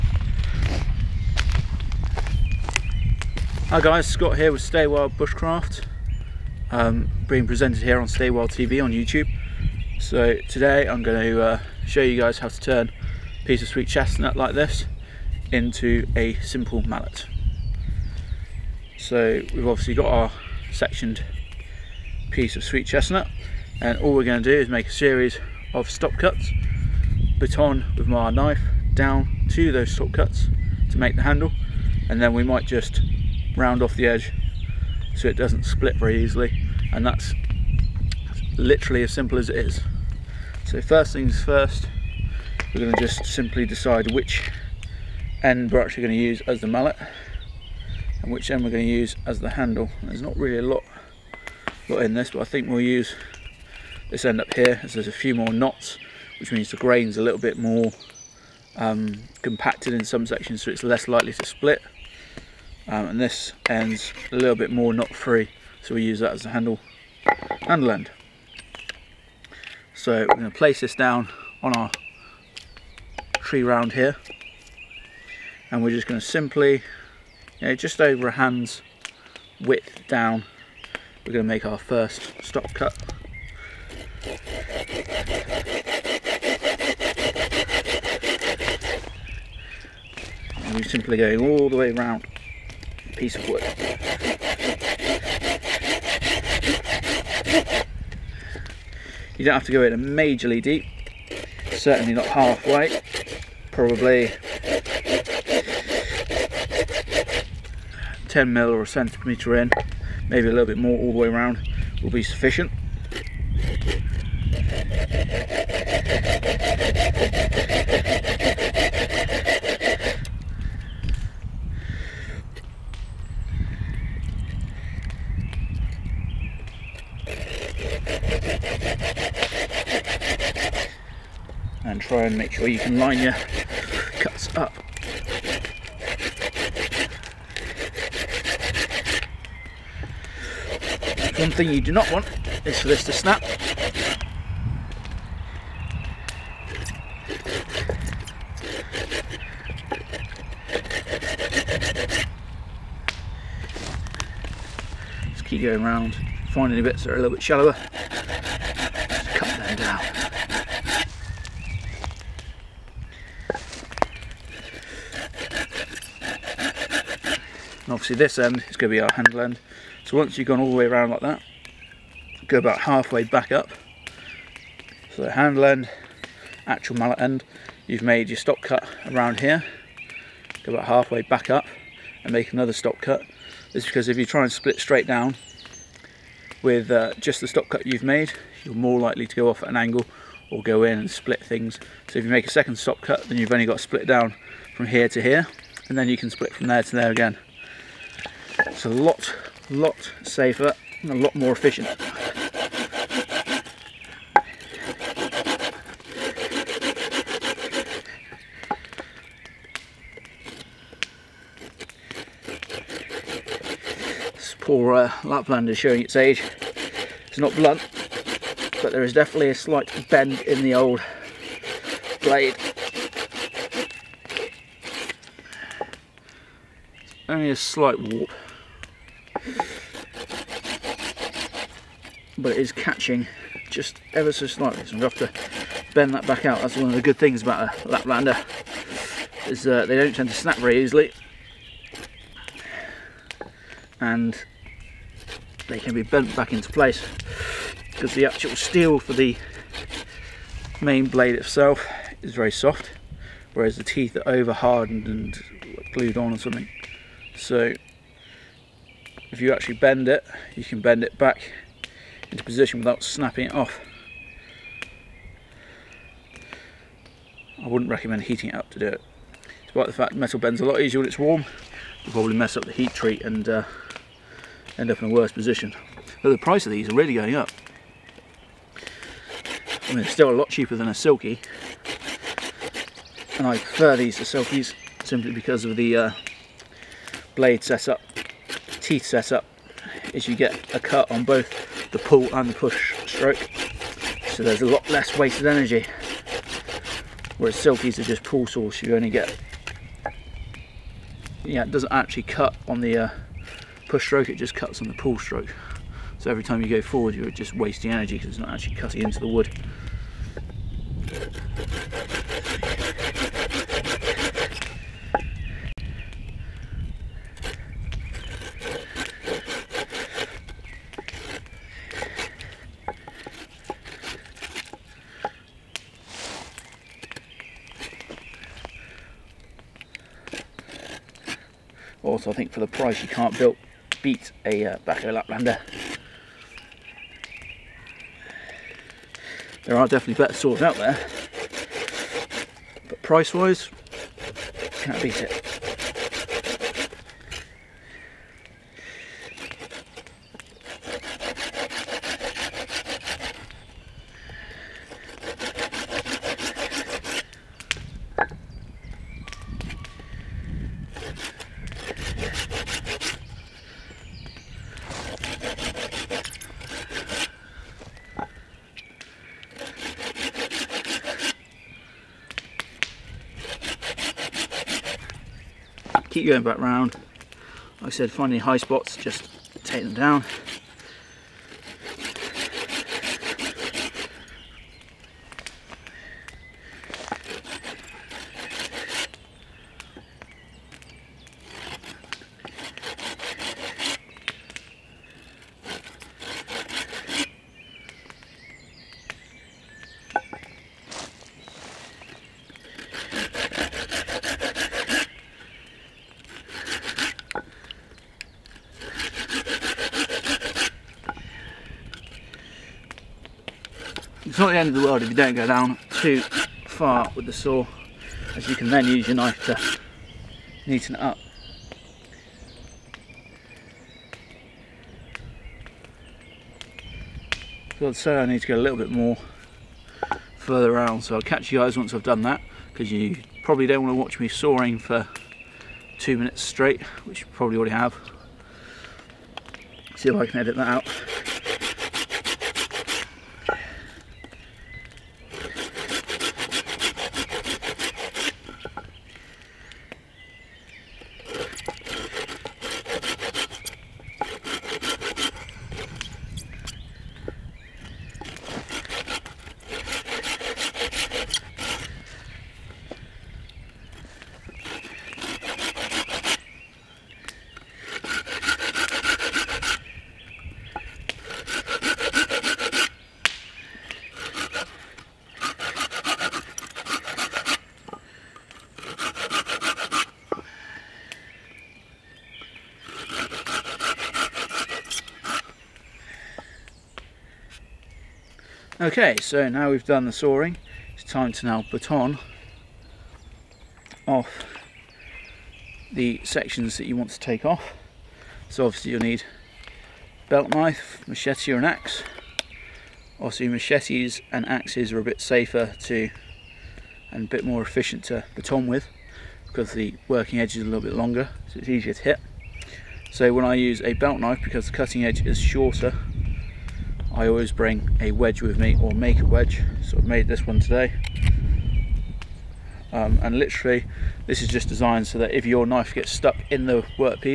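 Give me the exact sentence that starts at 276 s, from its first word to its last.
But the price of these are really going up.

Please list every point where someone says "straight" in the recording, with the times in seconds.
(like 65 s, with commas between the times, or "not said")
184 s, 436 s.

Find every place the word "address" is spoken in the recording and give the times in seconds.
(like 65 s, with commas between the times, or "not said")
not said.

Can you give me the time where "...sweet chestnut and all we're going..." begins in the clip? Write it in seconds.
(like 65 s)
22 s.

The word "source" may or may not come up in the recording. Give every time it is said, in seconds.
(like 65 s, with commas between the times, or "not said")
298 s.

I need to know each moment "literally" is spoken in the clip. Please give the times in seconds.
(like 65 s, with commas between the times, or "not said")
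38 s, 523 s.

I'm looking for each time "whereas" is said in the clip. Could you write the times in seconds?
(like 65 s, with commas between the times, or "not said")
253 s, 297 s.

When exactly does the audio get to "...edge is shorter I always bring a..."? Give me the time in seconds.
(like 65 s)
515 s.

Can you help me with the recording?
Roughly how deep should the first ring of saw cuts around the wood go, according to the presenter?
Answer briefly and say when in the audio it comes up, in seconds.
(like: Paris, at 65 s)
1 centimetre, at 108 s.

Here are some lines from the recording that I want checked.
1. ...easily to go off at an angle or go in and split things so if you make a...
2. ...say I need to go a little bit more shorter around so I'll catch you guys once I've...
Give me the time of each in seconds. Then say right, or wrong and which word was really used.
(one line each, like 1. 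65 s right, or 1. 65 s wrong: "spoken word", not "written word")
1. 188 s wrong: "likely", not "easily"
2. 427 s wrong: "further", not "shorter".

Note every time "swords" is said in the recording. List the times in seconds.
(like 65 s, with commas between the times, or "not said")
340 s.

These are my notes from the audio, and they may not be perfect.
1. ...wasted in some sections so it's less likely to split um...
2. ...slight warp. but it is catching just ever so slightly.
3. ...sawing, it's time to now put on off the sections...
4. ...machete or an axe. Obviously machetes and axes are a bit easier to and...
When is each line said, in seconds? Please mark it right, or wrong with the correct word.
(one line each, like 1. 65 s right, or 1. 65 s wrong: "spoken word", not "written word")
1. 59 s wrong: "compacted", not "wasted"
2. 227 s right
3. 490 s right
4. 501 s wrong: "safer", not "easier".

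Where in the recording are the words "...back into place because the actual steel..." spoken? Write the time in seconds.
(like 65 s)
246 s.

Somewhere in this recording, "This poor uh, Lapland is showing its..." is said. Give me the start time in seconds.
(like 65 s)
214 s.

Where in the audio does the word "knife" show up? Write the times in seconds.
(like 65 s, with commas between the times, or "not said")
28 s, 419 s, 500 s, 514 s, 525 s.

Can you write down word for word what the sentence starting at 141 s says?
One thing you do not want is for this to snap.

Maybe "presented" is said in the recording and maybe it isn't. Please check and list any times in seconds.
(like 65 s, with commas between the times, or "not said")
7 s.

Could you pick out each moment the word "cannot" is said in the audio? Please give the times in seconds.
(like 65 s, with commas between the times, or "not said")
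not said.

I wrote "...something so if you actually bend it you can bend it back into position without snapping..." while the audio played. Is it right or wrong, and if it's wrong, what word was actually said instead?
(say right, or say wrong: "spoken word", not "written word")
right.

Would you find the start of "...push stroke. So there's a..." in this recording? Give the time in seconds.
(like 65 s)
292 s.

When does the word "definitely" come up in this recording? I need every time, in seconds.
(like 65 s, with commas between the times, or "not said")
219 s, 339 s.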